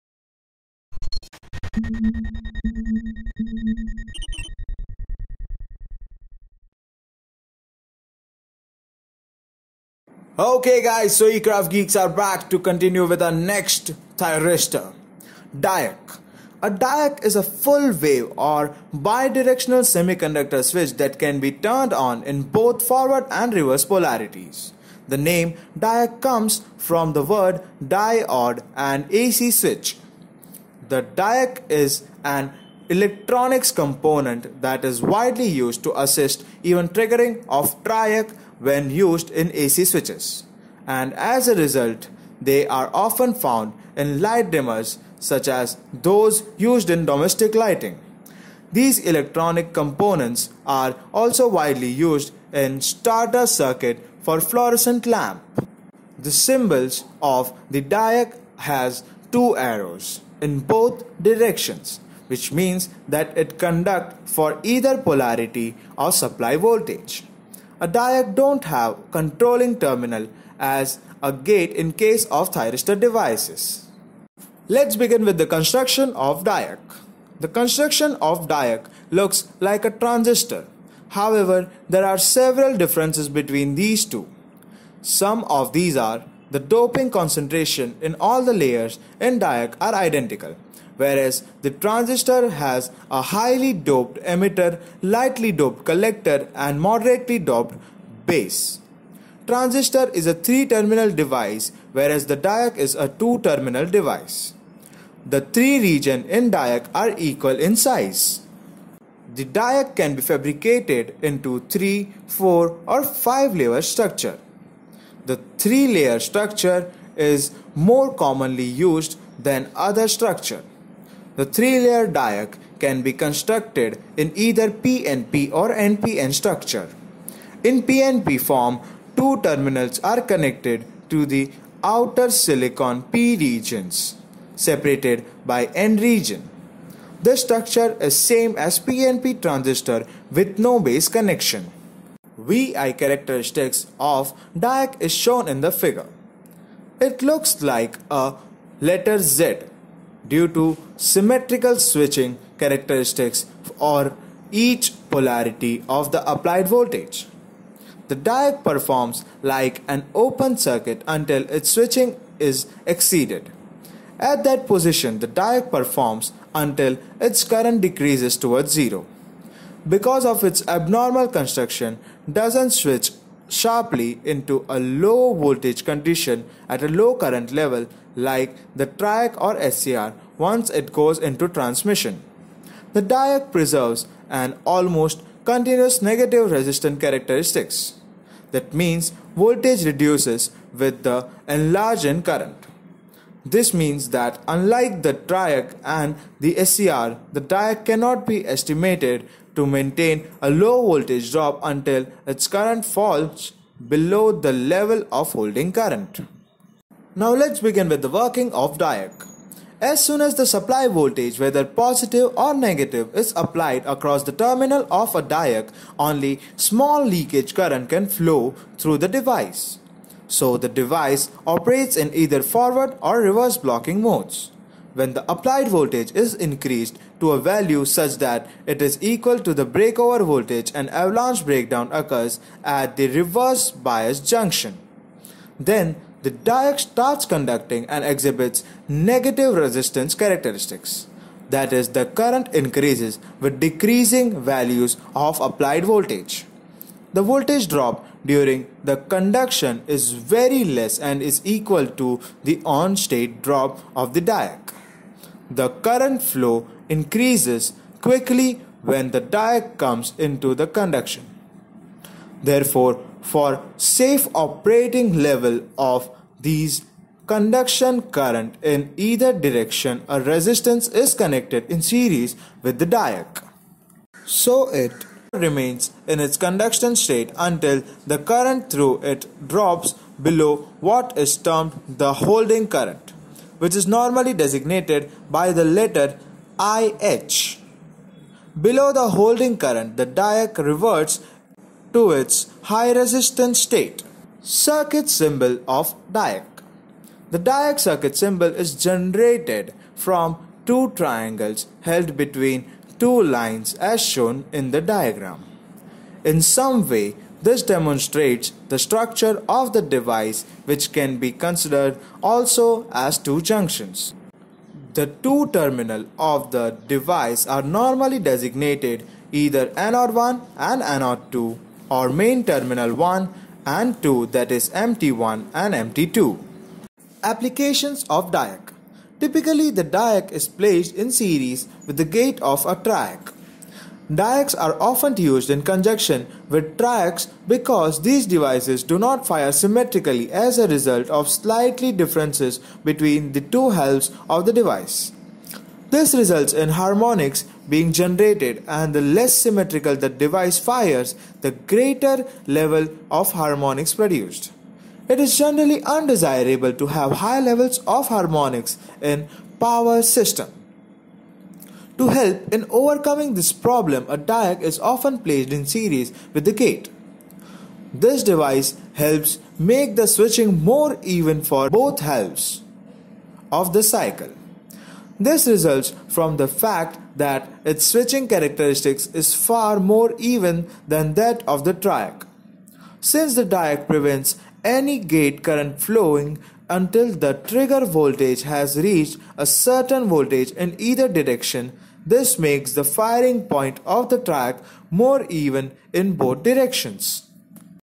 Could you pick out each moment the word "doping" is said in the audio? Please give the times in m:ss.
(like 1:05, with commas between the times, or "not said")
1:26.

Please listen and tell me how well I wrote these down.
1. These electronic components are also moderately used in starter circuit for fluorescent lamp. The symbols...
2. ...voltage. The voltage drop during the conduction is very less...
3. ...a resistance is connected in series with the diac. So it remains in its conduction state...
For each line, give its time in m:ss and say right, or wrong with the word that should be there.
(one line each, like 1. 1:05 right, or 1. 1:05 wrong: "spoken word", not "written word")
1. 0:48 wrong: "widely", not "moderately"
2. 4:05 right
3. 4:30 right.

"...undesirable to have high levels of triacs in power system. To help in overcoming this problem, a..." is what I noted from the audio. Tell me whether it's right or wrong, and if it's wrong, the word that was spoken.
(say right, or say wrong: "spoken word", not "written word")
wrong: "harmonics", not "triacs".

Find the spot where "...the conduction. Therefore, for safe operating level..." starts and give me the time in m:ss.
4:20.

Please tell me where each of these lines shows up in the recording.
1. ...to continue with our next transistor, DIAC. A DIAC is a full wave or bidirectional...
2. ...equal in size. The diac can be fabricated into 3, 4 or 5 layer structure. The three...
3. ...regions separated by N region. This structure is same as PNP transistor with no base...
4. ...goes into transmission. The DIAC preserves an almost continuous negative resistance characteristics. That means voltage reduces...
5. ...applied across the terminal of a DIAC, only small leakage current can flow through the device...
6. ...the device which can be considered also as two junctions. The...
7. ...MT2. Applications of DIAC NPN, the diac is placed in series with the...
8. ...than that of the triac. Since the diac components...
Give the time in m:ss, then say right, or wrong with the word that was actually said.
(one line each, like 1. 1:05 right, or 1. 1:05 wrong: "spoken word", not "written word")
1. 0:12 wrong: "thyristor", not "transistor"
2. 1:47 right
3. 2:13 right
4. 3:00 right
5. 3:33 right
6. 5:09 right
7. 5:25 wrong: "Typically", not "NPN"
8. 6:20 wrong: "prevents", not "components".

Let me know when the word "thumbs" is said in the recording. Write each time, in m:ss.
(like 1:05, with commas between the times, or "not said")
not said.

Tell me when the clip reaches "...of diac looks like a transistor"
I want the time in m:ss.
1:18.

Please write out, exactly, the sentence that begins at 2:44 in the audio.
At that position, the diac performs until its current decreases towards zero.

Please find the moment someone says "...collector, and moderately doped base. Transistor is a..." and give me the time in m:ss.
1:35.